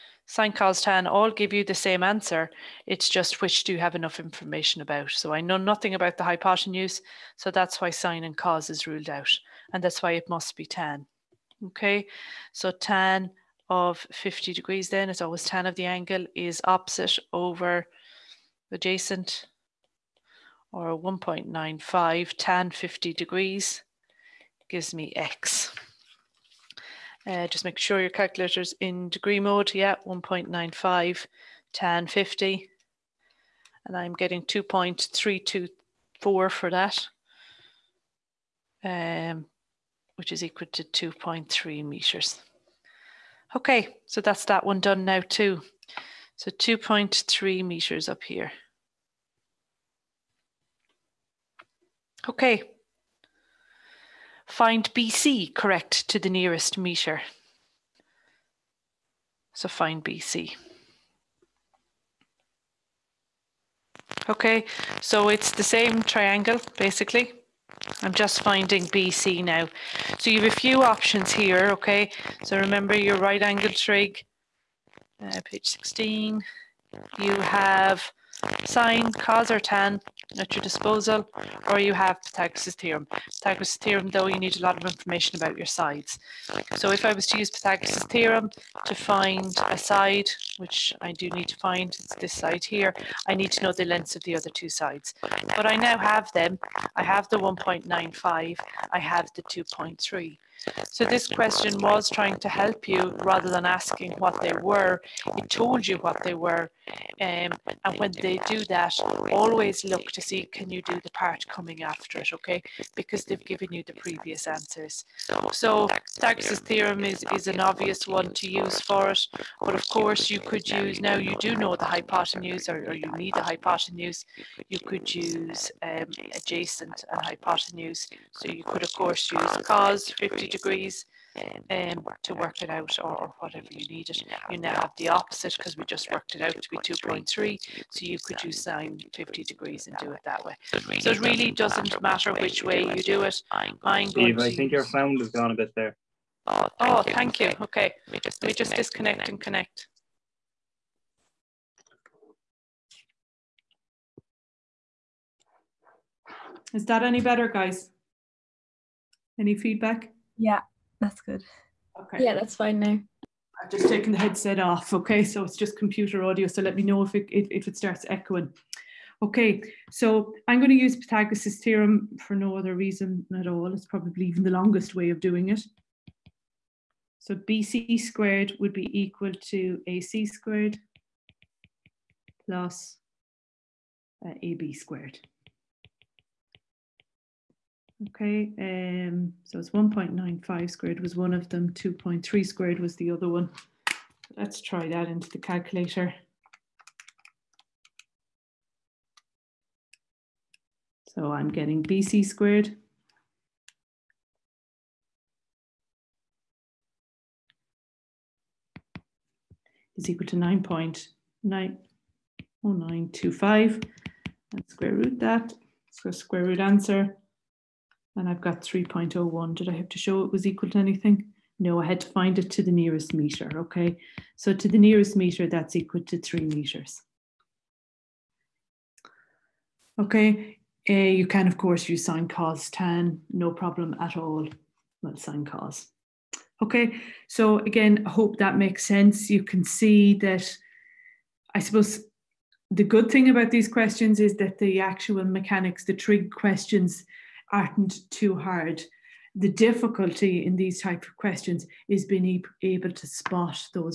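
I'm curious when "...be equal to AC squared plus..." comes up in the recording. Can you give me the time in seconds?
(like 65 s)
178 s.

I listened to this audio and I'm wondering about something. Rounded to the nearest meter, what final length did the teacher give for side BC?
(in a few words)
3 meters.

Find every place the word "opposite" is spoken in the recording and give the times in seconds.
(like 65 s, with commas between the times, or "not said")
16 s, 135 s.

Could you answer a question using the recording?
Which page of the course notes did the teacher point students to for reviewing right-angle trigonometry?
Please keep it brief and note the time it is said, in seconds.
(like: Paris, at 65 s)
page 16, at 75 s.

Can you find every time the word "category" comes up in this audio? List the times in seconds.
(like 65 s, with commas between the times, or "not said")
not said.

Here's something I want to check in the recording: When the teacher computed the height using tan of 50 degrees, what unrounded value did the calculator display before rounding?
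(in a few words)
2.324.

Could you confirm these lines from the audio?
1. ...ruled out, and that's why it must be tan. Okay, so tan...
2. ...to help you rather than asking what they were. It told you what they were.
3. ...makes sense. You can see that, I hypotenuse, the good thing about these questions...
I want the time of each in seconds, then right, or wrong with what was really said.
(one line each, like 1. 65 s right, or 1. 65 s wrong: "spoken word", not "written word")
1. 8 s right
2. 102 s right
3. 238 s wrong: "suppose", not "hypotenuse".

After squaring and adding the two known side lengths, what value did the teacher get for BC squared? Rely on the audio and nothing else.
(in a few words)
9.90925.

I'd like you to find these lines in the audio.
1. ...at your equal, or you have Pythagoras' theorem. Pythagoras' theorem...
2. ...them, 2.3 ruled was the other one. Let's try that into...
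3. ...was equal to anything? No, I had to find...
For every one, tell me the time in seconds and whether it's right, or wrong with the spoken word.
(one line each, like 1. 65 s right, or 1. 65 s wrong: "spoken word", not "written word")
1. 80 s wrong: "disposal", not "equal"
2. 191 s wrong: "squared", not "ruled"
3. 220 s right.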